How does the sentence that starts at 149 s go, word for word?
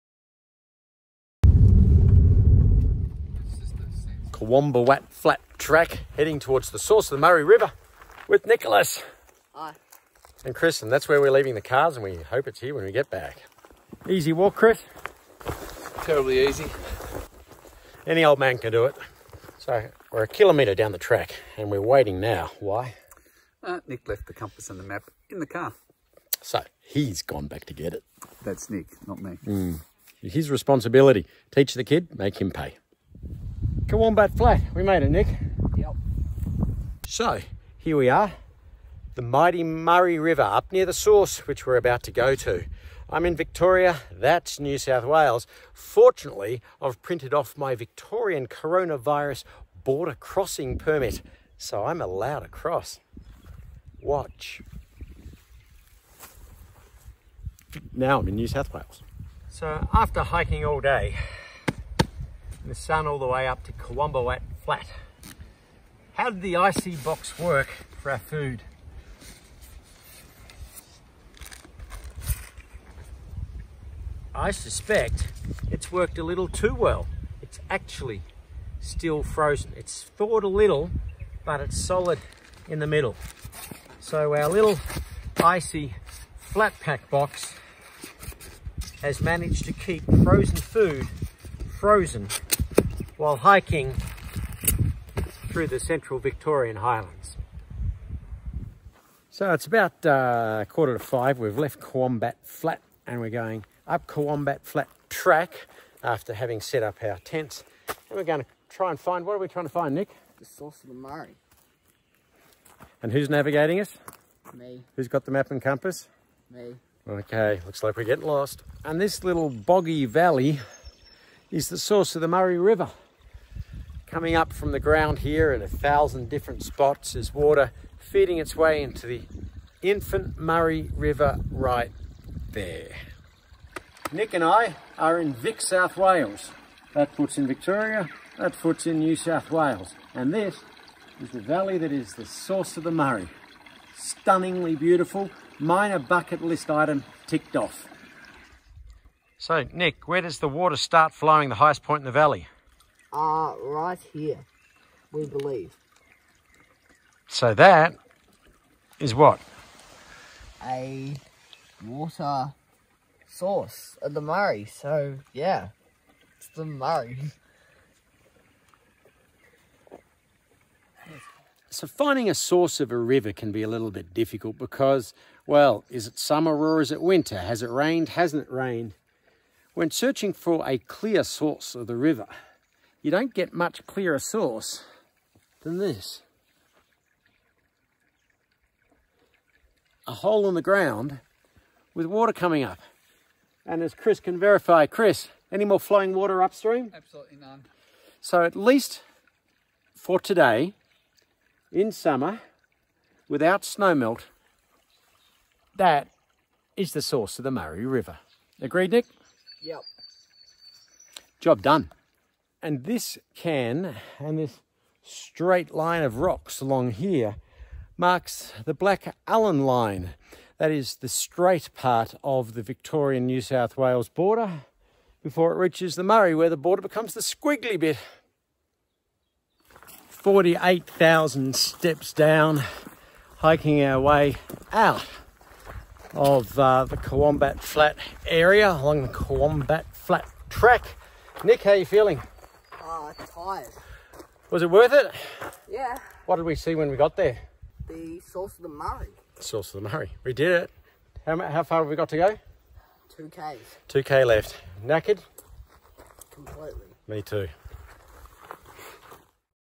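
So Nick, where does the water start flowing the highest point in the valley?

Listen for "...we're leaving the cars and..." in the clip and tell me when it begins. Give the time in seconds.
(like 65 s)
11 s.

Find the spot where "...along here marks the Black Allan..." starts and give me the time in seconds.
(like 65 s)
216 s.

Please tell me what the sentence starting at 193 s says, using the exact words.
And as Chris can verify, Chris, any more flowing water upstream?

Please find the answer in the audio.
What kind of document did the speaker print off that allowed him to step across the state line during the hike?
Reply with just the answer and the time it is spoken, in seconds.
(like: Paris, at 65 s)
Victorian coronavirus border crossing permit, at 47 s.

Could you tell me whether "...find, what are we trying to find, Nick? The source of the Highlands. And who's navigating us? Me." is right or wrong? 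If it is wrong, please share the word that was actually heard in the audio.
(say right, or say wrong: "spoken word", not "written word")
wrong: "Murray", not "Highlands".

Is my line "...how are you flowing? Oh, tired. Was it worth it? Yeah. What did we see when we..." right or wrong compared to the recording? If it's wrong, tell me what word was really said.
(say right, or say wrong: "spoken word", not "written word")
wrong: "feeling", not "flowing".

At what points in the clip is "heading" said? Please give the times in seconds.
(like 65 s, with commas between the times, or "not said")
6 s.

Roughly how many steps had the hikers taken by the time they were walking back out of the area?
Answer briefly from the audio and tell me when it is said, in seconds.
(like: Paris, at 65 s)
48,000, at 230 s.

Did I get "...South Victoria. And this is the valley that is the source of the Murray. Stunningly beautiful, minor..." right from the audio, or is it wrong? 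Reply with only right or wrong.
wrong.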